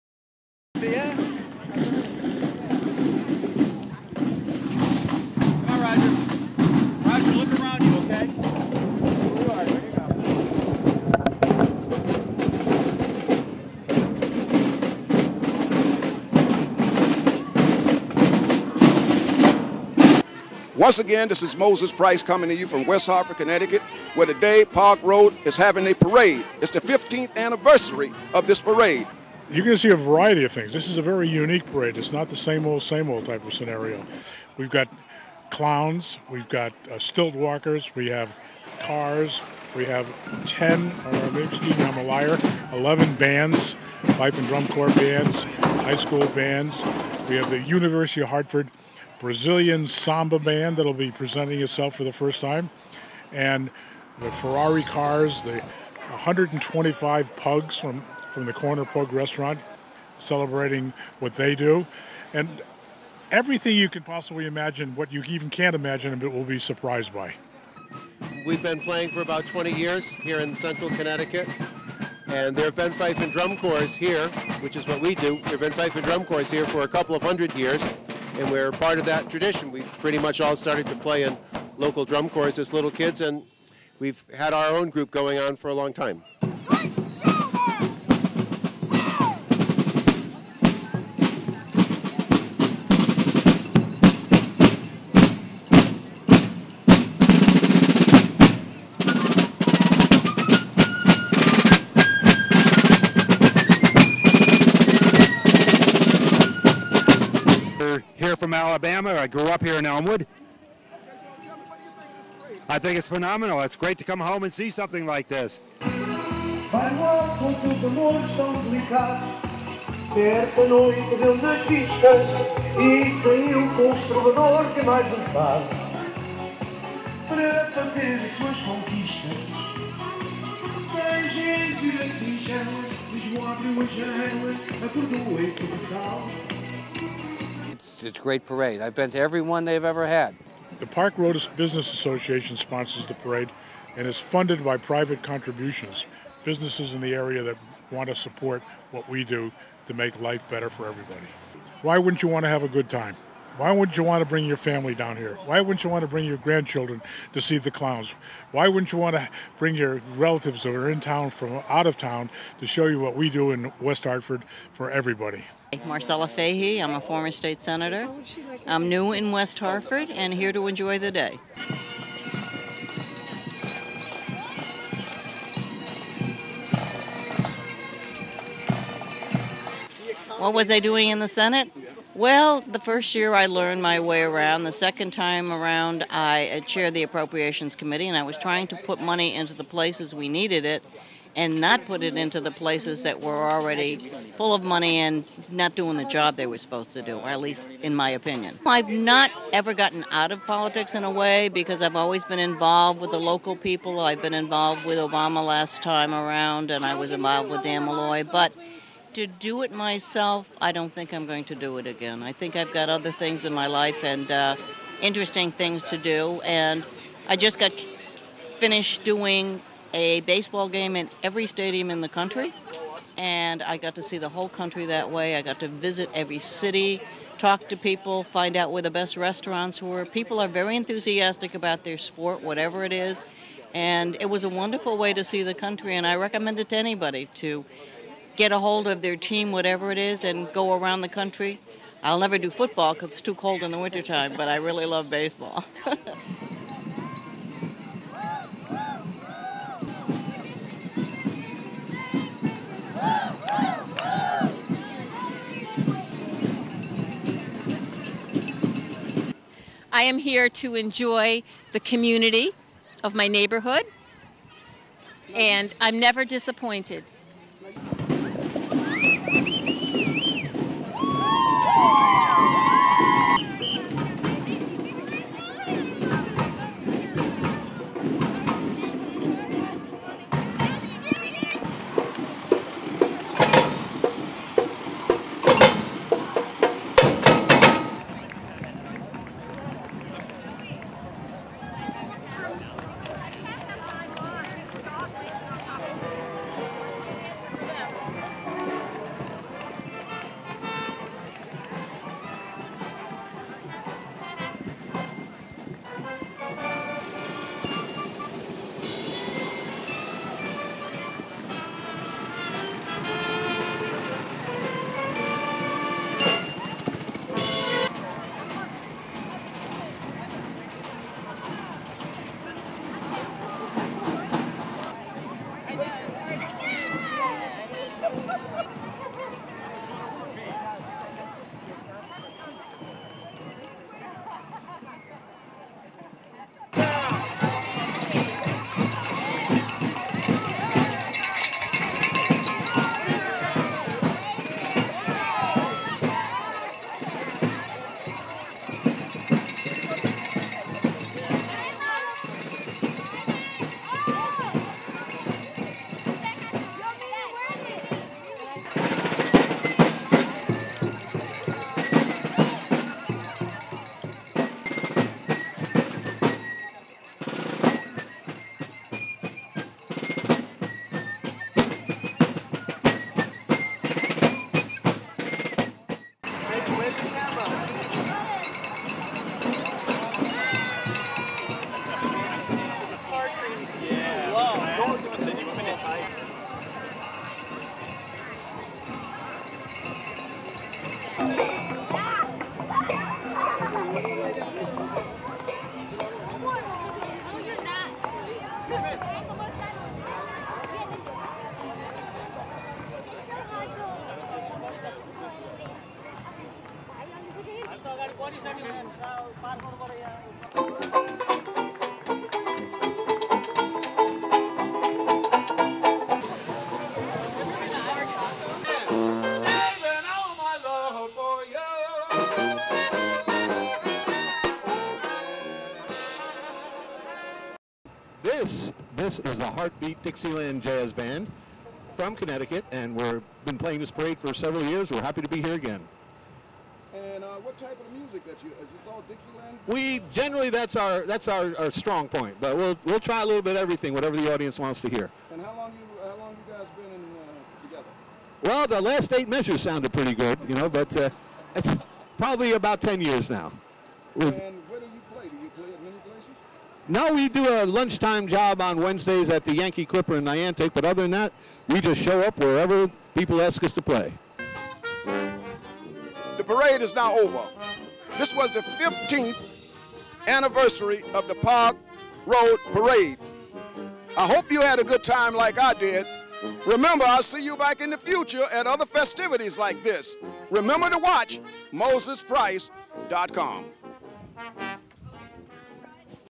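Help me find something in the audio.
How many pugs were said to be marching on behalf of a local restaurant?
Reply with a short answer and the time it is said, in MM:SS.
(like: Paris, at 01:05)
125, at 00:55.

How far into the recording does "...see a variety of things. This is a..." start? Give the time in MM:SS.
00:29.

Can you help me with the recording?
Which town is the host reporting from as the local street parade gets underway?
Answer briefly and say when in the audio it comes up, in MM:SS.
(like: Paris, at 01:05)
West Hartford, Connecticut, at 00:22.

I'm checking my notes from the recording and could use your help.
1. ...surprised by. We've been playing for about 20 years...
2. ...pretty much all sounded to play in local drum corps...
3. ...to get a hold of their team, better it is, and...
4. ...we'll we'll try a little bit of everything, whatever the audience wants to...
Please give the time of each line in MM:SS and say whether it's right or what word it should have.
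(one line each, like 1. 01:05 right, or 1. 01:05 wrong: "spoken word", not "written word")
1. 01:06 right
2. 01:19 wrong: "started", not "sounded"
3. 03:57 wrong: "whatever", not "better"
4. 07:22 right.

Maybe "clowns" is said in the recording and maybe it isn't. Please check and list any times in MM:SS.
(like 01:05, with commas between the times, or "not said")
00:35, 02:37.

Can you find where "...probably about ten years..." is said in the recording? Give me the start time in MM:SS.
07:32.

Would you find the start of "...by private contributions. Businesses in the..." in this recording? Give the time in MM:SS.
02:24.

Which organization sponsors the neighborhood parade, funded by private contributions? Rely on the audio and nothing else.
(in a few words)
Park Road Business Association.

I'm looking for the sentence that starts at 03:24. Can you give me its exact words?
I've been involved with Obama last time around, and I was involved with Dan Malloy.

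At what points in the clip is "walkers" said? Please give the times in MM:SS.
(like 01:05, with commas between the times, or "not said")
00:37.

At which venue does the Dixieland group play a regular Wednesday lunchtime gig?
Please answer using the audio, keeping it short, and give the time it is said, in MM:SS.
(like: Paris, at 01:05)
Yankee Clipper, at 07:39.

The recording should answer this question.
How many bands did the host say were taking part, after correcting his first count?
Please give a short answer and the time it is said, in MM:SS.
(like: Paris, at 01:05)
11, at 00:42.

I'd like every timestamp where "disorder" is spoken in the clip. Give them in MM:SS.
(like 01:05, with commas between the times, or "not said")
not said.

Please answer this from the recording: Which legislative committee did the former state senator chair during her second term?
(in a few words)
Appropriations Committee.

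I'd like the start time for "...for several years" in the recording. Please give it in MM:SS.
07:14.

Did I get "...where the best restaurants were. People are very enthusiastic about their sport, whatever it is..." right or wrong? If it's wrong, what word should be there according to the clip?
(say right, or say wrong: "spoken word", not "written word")
right.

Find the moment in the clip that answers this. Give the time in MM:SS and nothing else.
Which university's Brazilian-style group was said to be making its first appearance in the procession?
00:47.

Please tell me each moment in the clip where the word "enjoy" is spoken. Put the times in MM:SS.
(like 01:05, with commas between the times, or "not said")
02:50, 04:20.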